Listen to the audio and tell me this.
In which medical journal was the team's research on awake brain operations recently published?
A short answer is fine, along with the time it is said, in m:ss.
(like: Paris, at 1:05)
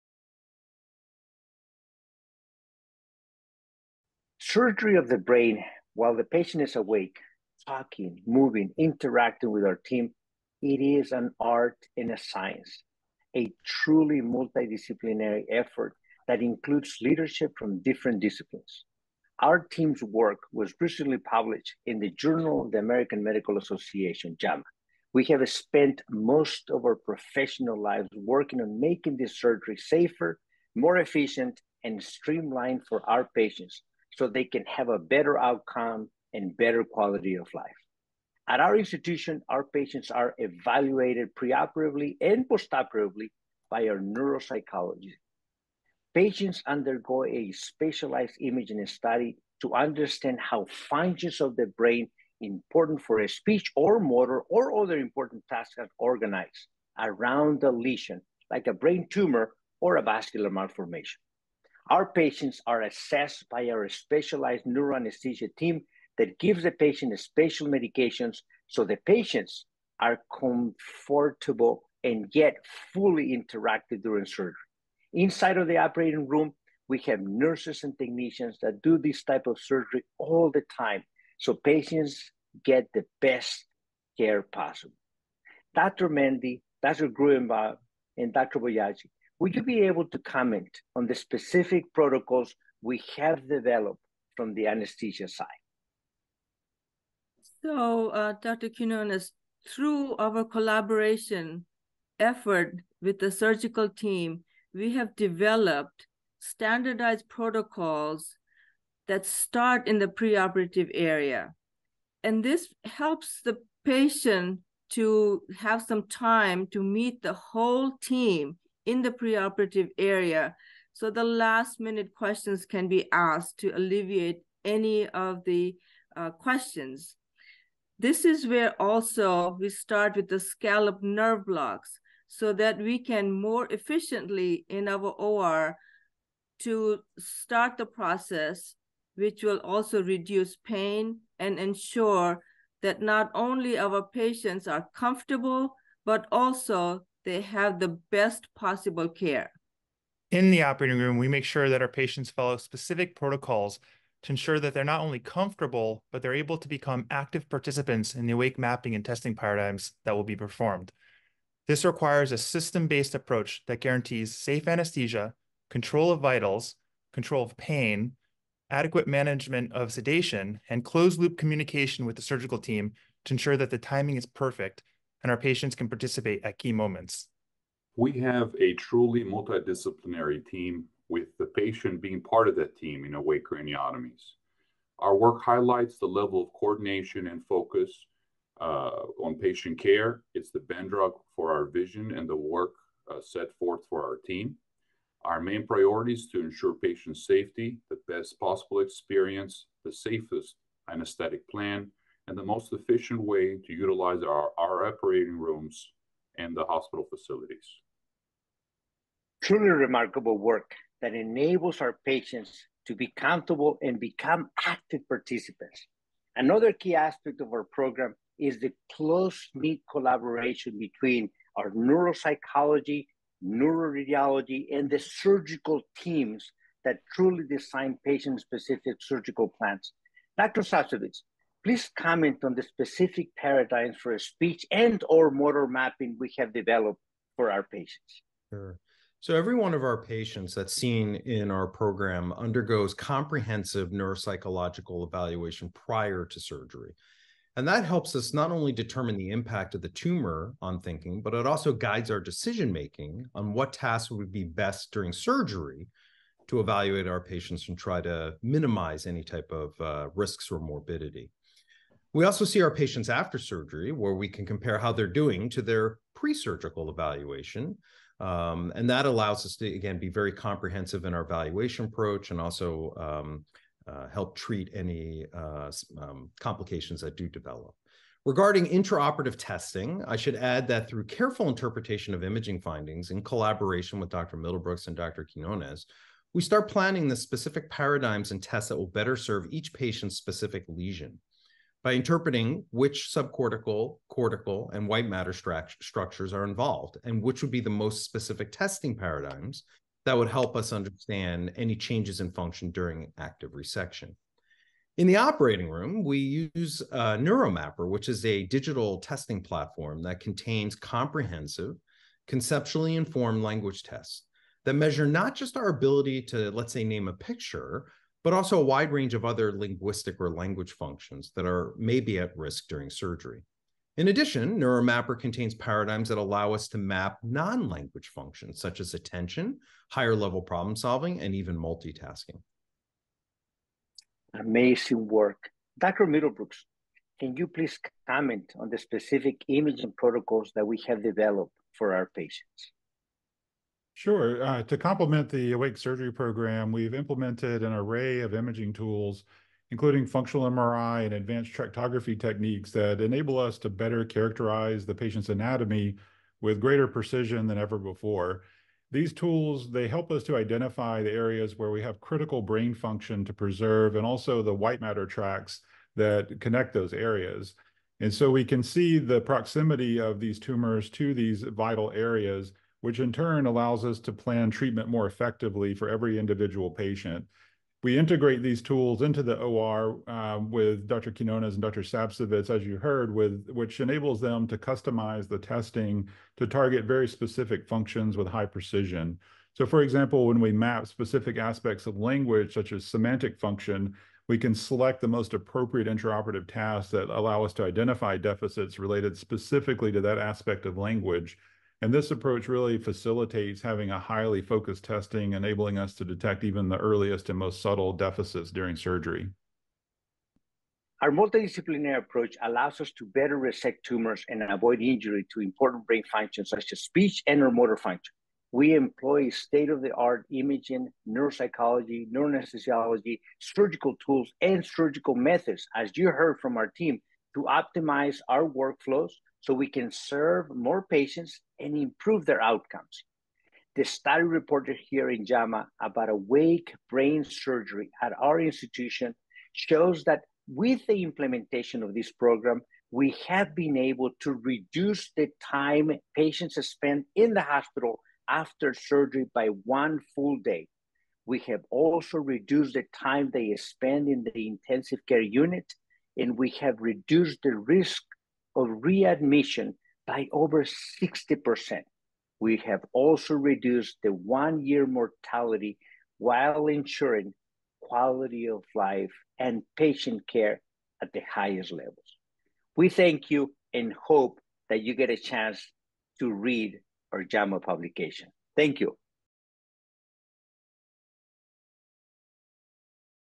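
Journal of the American Medical Association, at 0:22.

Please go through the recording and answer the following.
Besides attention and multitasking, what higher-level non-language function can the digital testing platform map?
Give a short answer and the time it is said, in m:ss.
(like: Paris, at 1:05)
problem solving, at 5:29.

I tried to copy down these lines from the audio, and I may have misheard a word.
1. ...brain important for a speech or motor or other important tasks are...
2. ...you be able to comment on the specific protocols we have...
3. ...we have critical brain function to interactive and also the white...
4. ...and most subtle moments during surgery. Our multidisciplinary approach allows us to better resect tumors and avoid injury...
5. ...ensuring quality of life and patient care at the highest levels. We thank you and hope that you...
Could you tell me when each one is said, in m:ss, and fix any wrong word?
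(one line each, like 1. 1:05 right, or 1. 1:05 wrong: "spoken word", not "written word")
1. 0:51 right
2. 1:29 right
3. 6:01 wrong: "preserve", not "interactive"
4. 6:47 wrong: "deficits", not "moments"
5. 7:46 right.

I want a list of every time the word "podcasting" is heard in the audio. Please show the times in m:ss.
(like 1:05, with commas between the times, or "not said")
not said.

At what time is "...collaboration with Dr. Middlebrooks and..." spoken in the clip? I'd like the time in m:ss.
4:43.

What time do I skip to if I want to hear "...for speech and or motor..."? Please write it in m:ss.
3:54.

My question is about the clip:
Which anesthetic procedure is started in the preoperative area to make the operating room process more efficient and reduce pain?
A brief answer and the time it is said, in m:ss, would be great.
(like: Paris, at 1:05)
scalp nerve blocks, at 2:10.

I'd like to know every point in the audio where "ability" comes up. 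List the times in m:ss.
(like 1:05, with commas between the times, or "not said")
5:15.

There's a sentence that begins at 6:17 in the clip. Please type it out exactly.
We integrate these tools into the OR uh, um, with Dr.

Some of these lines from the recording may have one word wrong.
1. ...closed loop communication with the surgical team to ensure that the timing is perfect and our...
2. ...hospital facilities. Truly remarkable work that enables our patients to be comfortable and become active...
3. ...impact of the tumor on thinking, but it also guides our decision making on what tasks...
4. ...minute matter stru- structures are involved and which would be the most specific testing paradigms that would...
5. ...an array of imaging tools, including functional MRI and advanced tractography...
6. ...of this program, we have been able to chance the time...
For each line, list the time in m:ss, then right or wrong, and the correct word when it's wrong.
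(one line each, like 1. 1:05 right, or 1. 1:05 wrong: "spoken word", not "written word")
1. 2:50 right
2. 3:26 right
3. 4:09 right
4. 4:54 wrong: "white", not "minute"
5. 5:47 right
6. 7:21 wrong: "reduce", not "chance".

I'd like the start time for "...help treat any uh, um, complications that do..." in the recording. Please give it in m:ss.
4:34.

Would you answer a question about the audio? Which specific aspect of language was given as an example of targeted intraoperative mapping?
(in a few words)
semantic function.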